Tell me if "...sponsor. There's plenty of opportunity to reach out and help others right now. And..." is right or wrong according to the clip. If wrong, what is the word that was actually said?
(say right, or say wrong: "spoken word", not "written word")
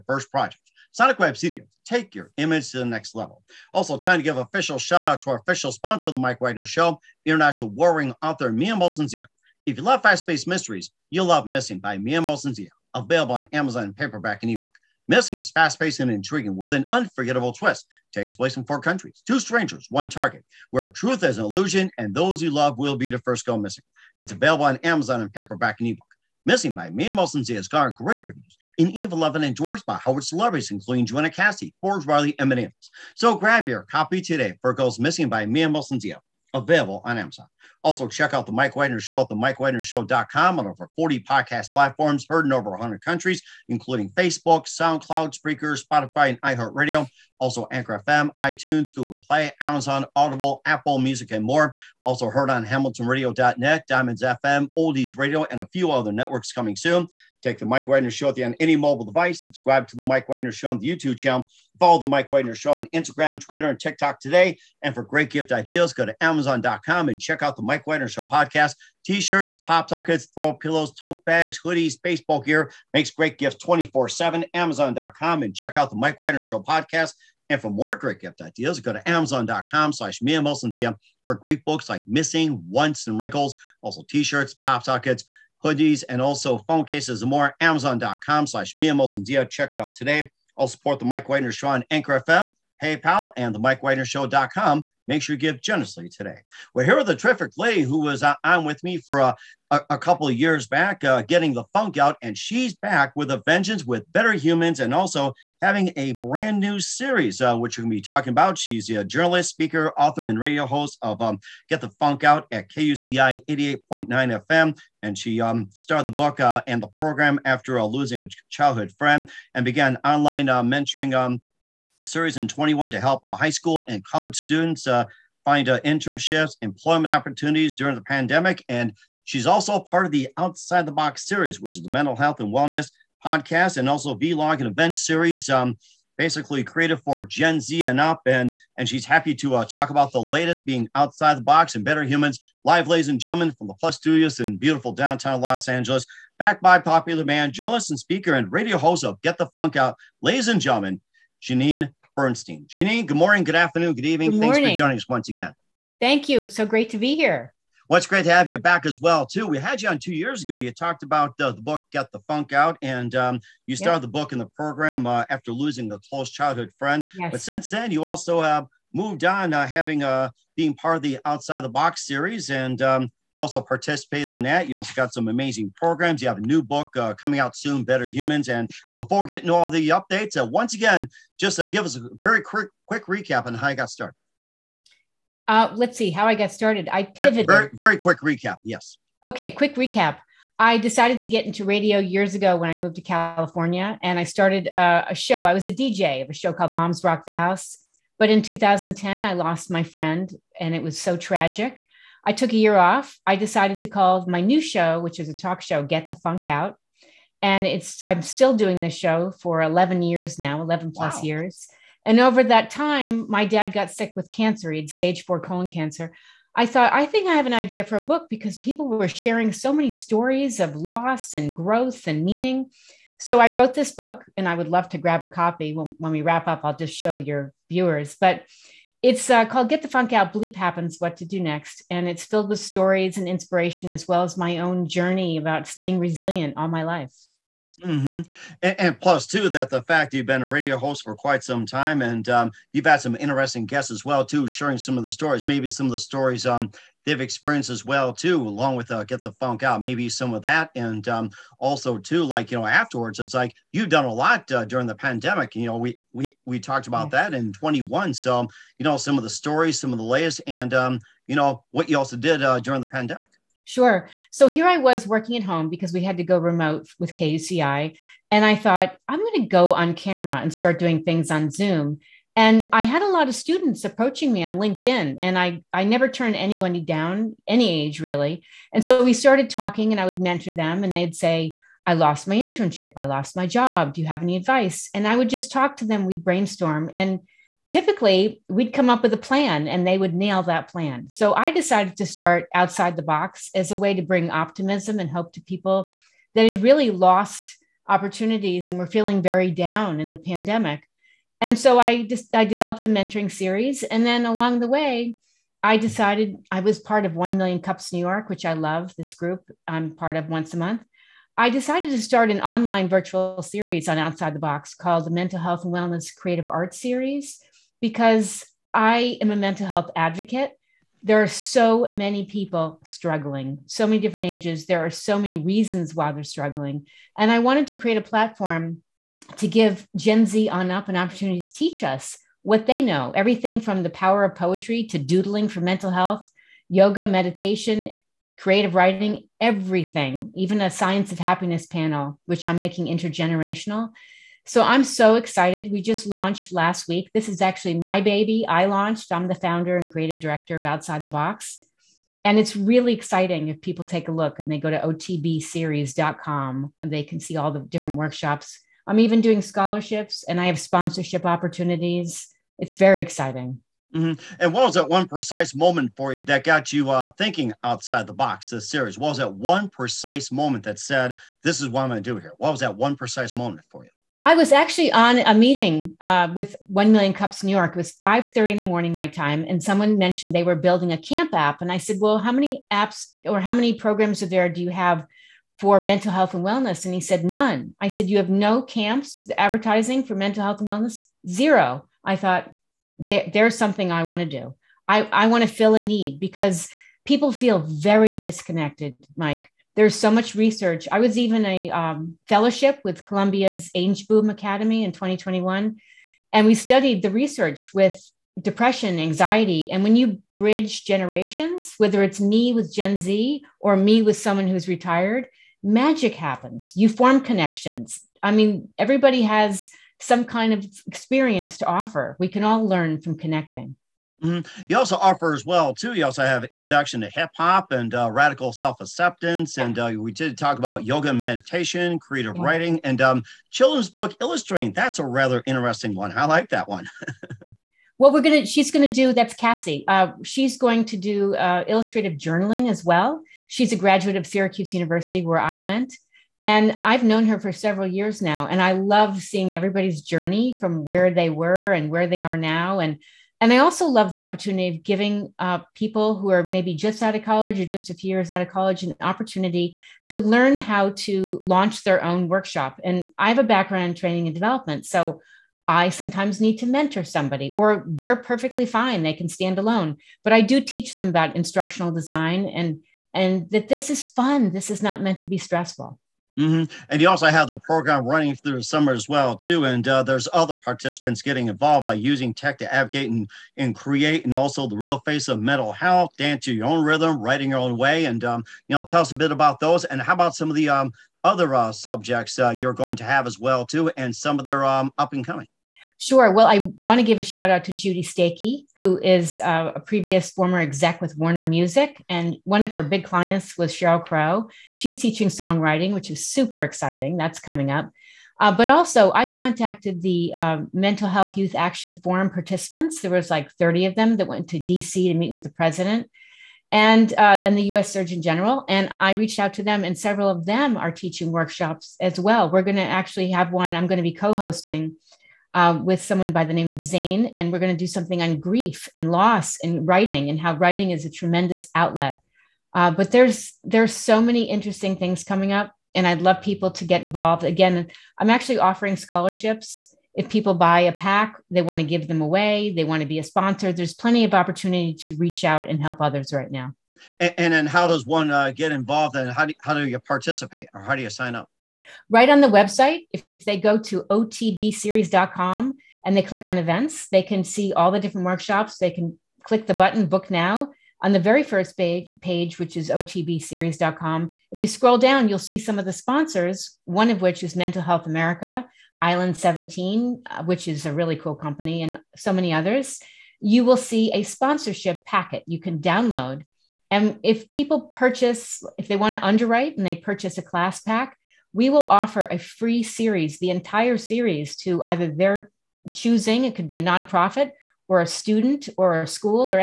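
right.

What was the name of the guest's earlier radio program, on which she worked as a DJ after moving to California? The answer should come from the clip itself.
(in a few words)
Moms Rock the House.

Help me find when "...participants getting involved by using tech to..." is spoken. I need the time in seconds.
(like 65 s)
480 s.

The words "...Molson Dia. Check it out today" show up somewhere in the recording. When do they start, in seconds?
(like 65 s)
88 s.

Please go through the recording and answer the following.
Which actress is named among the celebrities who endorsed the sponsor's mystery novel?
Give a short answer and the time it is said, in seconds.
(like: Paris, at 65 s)
Joanna Cassidy, at 31 s.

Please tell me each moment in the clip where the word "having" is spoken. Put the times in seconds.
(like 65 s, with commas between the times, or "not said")
105 s, 169 s.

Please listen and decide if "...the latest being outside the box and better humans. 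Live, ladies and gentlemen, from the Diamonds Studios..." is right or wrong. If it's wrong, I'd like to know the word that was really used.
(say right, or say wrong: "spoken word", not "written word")
wrong: "Plus", not "Diamonds".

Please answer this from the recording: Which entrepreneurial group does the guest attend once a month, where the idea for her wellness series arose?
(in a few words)
1 Million Cups New York.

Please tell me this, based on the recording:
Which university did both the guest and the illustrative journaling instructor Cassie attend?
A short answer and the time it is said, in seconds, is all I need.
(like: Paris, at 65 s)
Syracuse University, at 444 s.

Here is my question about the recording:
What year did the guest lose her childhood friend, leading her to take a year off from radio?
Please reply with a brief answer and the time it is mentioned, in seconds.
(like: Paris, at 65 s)
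2010, at 198 s.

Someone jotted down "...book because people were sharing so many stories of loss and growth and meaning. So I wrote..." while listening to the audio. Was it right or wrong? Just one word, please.
right.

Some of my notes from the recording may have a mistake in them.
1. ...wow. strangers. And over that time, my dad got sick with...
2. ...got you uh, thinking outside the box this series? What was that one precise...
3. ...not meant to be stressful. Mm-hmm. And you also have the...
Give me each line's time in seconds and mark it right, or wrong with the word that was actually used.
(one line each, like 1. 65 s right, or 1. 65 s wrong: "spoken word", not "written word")
1. 211 s wrong: "years", not "strangers"
2. 366 s right
3. 474 s right.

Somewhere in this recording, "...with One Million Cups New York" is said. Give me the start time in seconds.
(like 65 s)
376 s.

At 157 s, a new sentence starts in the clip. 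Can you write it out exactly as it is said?
Well, it's great to have you back as well, too.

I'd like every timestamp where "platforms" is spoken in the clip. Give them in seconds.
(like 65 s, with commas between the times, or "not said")
41 s, 328 s.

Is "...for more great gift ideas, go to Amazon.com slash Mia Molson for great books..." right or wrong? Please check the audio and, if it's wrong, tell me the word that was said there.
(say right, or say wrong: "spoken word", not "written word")
right.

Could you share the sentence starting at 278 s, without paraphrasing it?
And so we started talking, and I would mentor them, and they'd say, I lost my internship.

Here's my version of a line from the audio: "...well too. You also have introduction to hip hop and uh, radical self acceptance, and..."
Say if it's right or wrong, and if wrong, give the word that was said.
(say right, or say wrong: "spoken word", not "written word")
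right.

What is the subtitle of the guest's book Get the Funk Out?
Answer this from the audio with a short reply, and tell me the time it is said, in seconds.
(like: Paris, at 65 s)
Bleep Happens, What to Do Next, at 230 s.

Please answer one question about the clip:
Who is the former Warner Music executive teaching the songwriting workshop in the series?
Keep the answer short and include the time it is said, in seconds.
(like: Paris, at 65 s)
Judy Stakee, at 497 s.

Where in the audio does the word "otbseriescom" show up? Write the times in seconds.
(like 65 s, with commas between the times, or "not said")
354 s, 554 s, 562 s.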